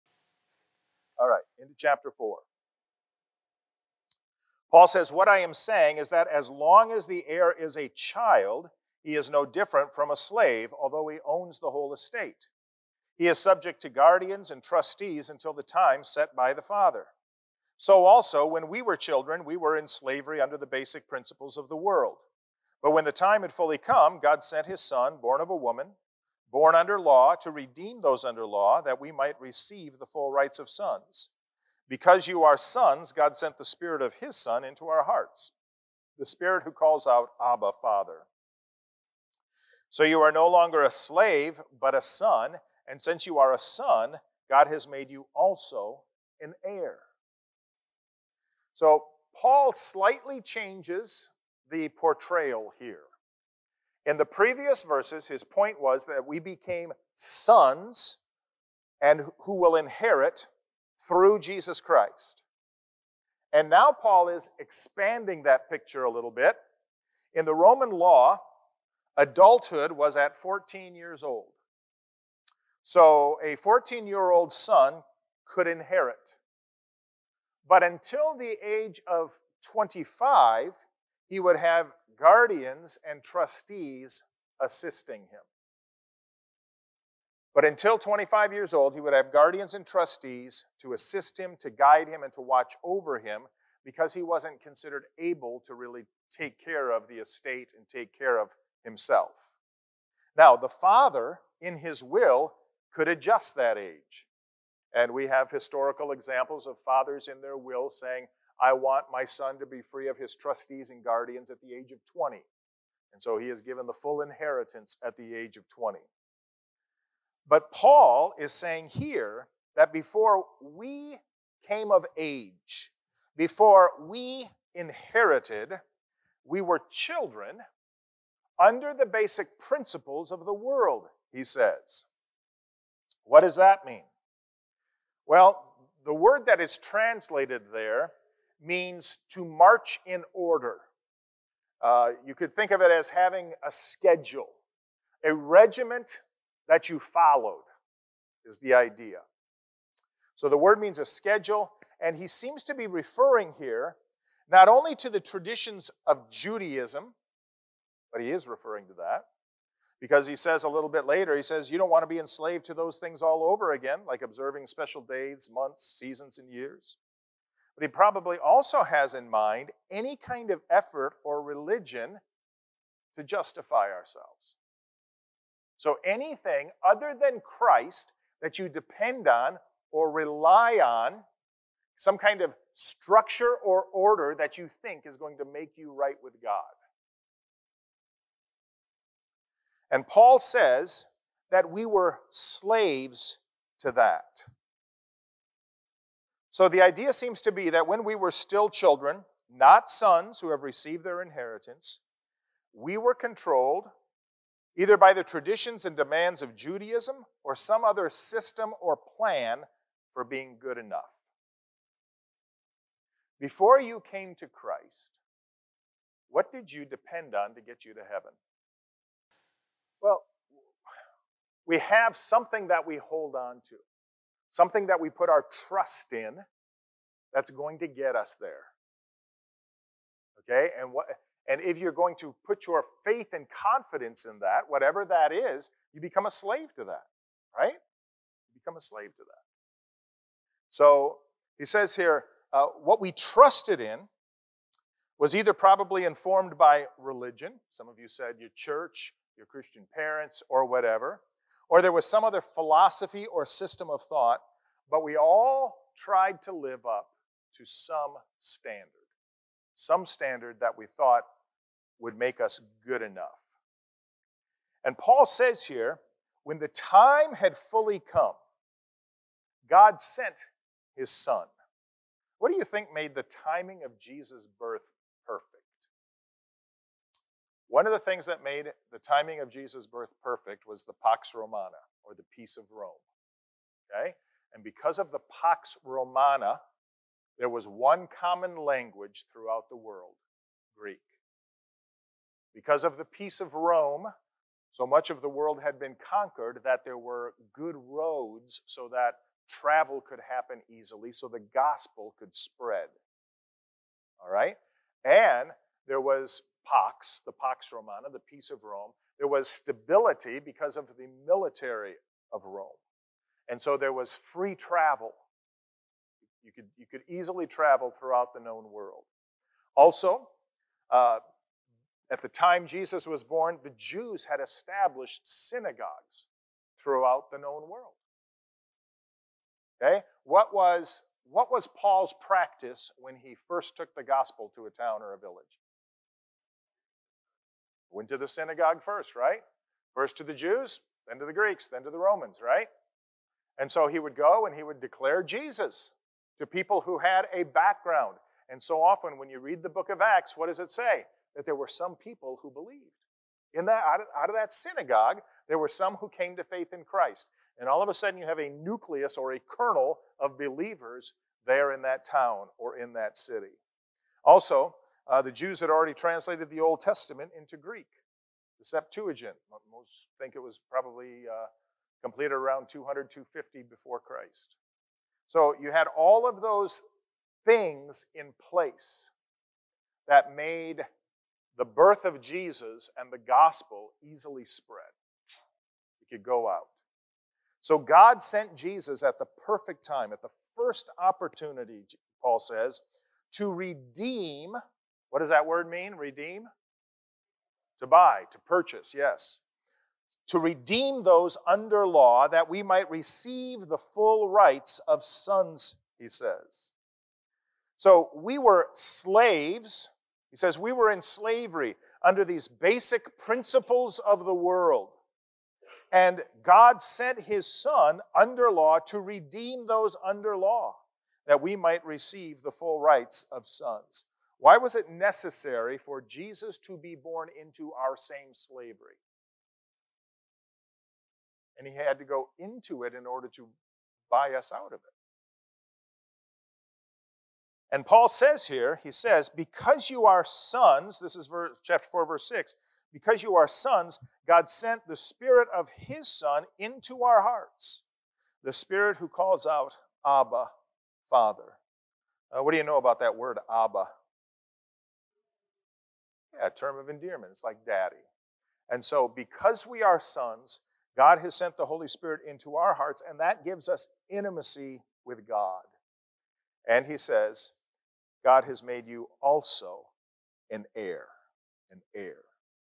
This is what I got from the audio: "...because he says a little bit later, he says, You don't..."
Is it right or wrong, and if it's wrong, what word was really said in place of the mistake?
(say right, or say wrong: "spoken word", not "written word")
right.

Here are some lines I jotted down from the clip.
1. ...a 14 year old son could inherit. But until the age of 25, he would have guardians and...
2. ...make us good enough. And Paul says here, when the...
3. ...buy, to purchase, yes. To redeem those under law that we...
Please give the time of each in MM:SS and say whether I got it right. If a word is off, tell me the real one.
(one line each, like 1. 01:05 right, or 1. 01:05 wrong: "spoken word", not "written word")
1. 01:13 right
2. 04:22 right
3. 06:37 right.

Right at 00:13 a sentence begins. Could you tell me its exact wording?
He is subject to guardians and trustees until the time set by the father.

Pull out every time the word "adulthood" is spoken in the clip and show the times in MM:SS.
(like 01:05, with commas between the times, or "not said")
01:09.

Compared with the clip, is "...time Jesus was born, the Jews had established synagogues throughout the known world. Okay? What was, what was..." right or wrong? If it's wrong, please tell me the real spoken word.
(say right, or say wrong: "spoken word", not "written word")
right.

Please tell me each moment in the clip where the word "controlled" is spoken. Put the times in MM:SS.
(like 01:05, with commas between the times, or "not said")
03:23.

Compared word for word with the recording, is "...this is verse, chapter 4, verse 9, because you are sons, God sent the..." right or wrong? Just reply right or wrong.
wrong.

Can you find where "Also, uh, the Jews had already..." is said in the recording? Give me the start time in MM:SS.
06:04.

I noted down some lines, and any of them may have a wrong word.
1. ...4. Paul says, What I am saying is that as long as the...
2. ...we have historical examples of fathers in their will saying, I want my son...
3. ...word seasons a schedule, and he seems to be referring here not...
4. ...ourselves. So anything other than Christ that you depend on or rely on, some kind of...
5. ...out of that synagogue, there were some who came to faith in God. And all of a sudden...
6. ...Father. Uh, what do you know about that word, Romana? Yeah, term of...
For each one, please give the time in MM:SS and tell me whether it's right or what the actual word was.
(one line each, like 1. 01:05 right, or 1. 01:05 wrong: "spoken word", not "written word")
1. 00:02 right
2. 01:45 right
3. 02:30 wrong: "means", not "seasons"
4. 02:53 right
5. 05:54 wrong: "Christ", not "God"
6. 07:31 wrong: "Abba", not "Romana".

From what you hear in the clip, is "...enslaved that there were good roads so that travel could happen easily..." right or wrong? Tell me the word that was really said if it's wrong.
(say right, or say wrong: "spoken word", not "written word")
wrong: "conquered", not "enslaved".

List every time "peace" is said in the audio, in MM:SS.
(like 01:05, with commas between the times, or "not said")
04:42, 04:53, 05:08.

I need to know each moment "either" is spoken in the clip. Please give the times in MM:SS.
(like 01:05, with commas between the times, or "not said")
03:24, 04:05.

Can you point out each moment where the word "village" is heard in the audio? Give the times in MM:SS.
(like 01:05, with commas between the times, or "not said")
05:35.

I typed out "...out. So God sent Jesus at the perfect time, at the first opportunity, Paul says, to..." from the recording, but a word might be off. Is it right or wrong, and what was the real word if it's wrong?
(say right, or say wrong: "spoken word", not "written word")
right.